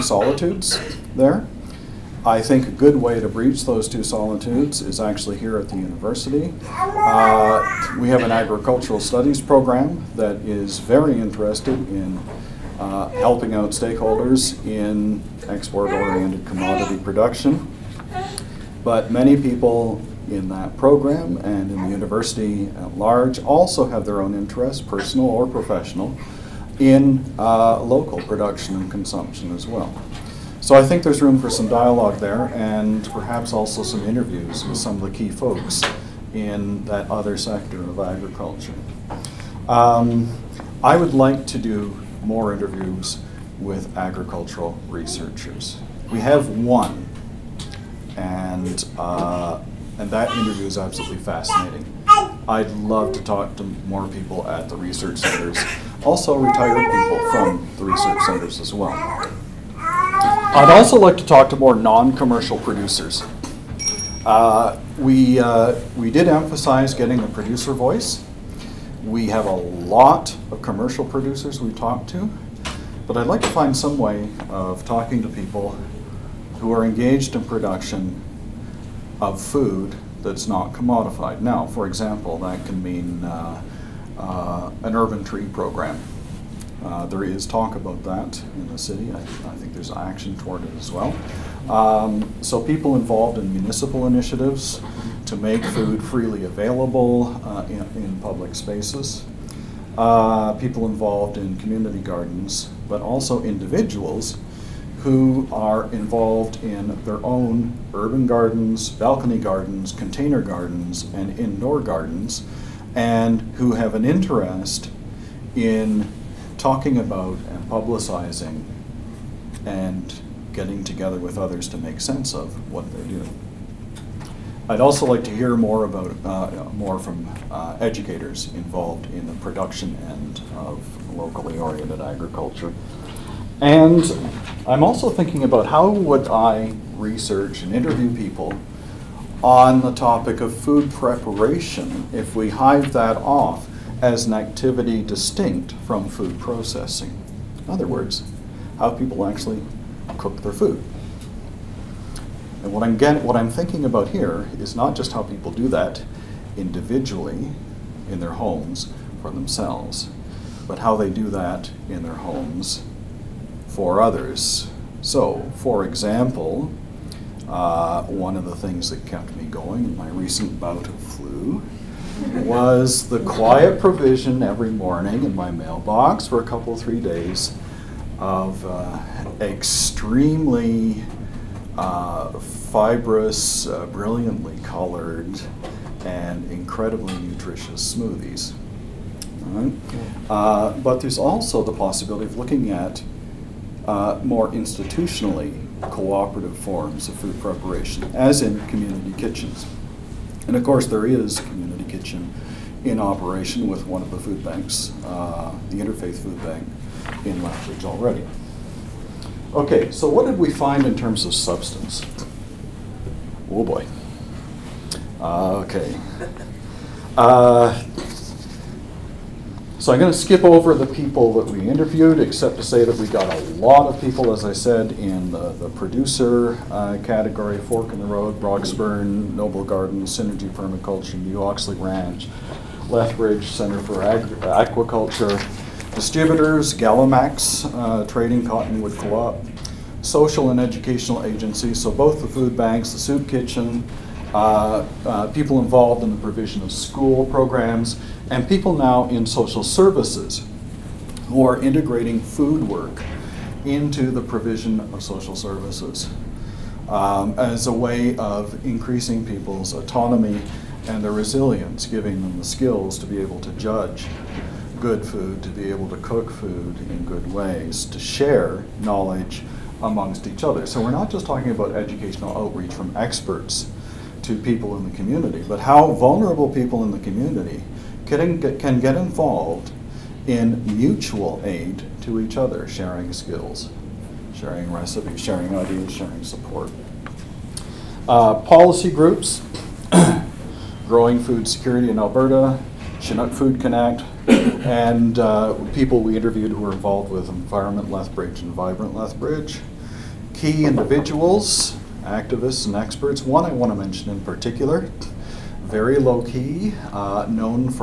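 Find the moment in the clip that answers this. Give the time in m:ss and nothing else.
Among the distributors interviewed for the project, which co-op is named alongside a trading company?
3:58.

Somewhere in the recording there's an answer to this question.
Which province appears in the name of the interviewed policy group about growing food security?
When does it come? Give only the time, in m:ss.
4:51.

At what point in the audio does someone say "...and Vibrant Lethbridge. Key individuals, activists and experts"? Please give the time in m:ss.
4:58.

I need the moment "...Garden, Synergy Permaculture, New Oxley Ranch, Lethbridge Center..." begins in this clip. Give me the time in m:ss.
3:49.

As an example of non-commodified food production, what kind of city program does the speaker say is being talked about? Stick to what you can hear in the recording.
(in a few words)
Urban tree program.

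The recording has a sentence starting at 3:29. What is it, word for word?
Okay, so what did we find in terms of substance?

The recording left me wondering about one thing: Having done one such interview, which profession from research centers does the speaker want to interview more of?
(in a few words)
Agricultural researchers.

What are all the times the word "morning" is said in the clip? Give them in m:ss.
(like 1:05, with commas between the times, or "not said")
2:54.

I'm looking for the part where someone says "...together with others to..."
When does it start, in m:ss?
2:00.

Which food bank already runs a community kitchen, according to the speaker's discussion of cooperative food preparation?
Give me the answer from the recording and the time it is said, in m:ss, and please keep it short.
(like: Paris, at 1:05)
Interfaith Food Bank, at 3:25.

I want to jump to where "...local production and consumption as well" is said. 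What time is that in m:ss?
0:27.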